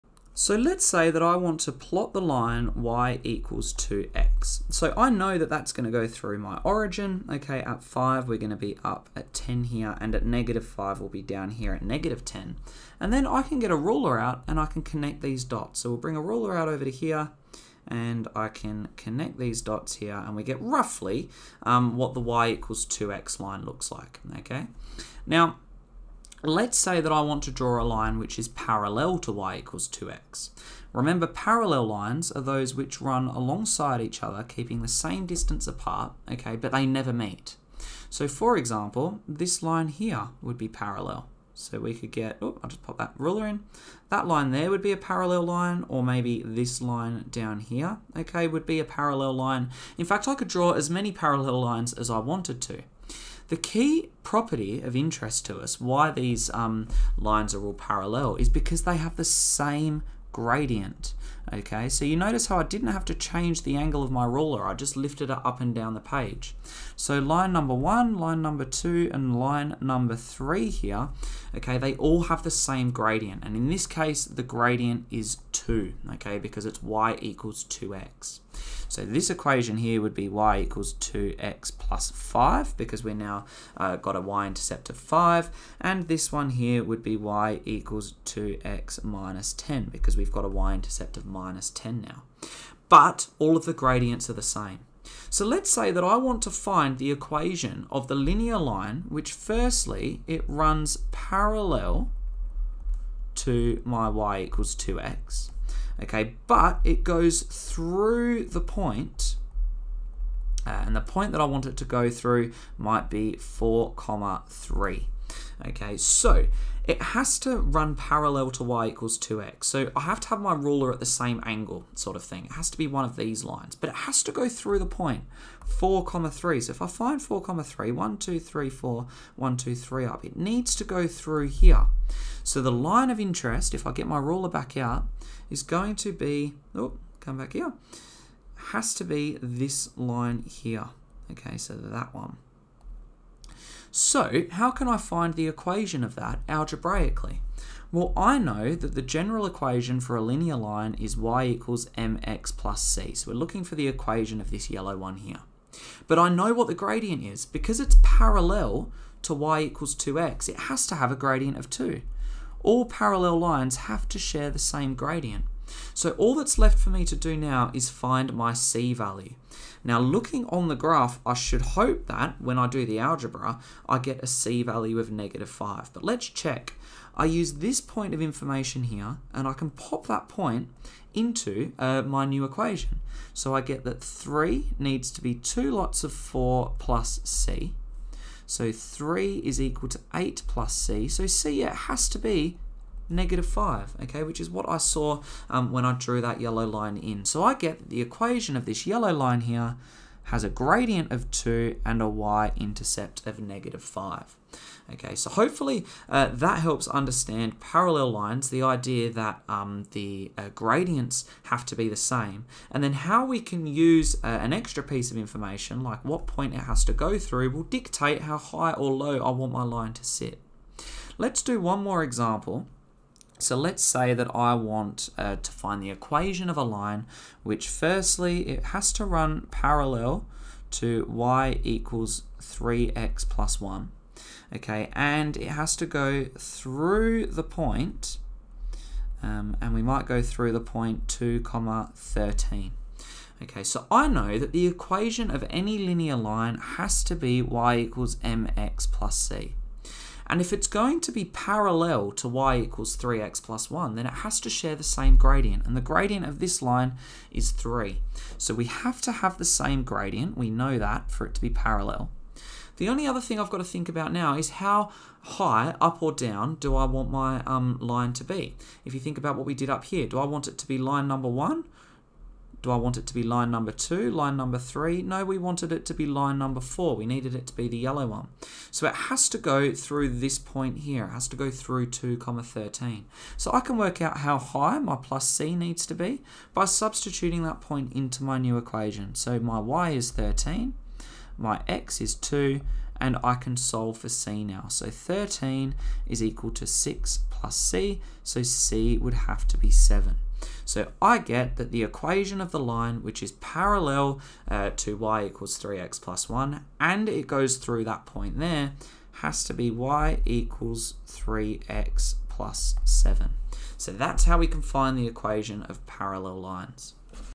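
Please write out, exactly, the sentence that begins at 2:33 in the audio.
So we're looking for the equation of this yellow one here.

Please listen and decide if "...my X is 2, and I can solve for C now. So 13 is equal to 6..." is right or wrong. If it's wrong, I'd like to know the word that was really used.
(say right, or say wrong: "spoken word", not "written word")
right.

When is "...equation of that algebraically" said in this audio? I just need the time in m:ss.
2:25.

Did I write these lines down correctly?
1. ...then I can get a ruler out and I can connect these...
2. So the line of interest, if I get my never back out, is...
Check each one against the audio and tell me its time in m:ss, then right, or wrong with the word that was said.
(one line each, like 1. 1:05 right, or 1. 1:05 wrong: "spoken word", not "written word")
1. 0:13 right
2. 2:12 wrong: "ruler", not "never".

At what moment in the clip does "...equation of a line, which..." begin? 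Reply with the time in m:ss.
3:45.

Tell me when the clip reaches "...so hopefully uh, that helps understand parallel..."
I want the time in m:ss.
3:25.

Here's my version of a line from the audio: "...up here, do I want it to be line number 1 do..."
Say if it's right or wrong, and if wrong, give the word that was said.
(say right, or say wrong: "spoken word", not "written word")
right.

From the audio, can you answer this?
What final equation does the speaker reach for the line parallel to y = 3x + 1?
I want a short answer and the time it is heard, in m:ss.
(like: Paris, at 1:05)
y = 3x + 7, at 5:09.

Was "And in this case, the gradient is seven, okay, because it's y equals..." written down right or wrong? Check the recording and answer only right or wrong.
wrong.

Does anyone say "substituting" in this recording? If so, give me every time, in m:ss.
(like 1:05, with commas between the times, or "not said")
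4:46.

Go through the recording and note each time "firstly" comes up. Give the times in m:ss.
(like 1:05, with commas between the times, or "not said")
1:39, 3:47.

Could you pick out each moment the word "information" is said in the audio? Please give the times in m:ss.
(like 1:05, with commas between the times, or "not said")
2:58, 3:35.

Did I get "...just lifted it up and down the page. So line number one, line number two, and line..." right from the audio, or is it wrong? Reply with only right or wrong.
right.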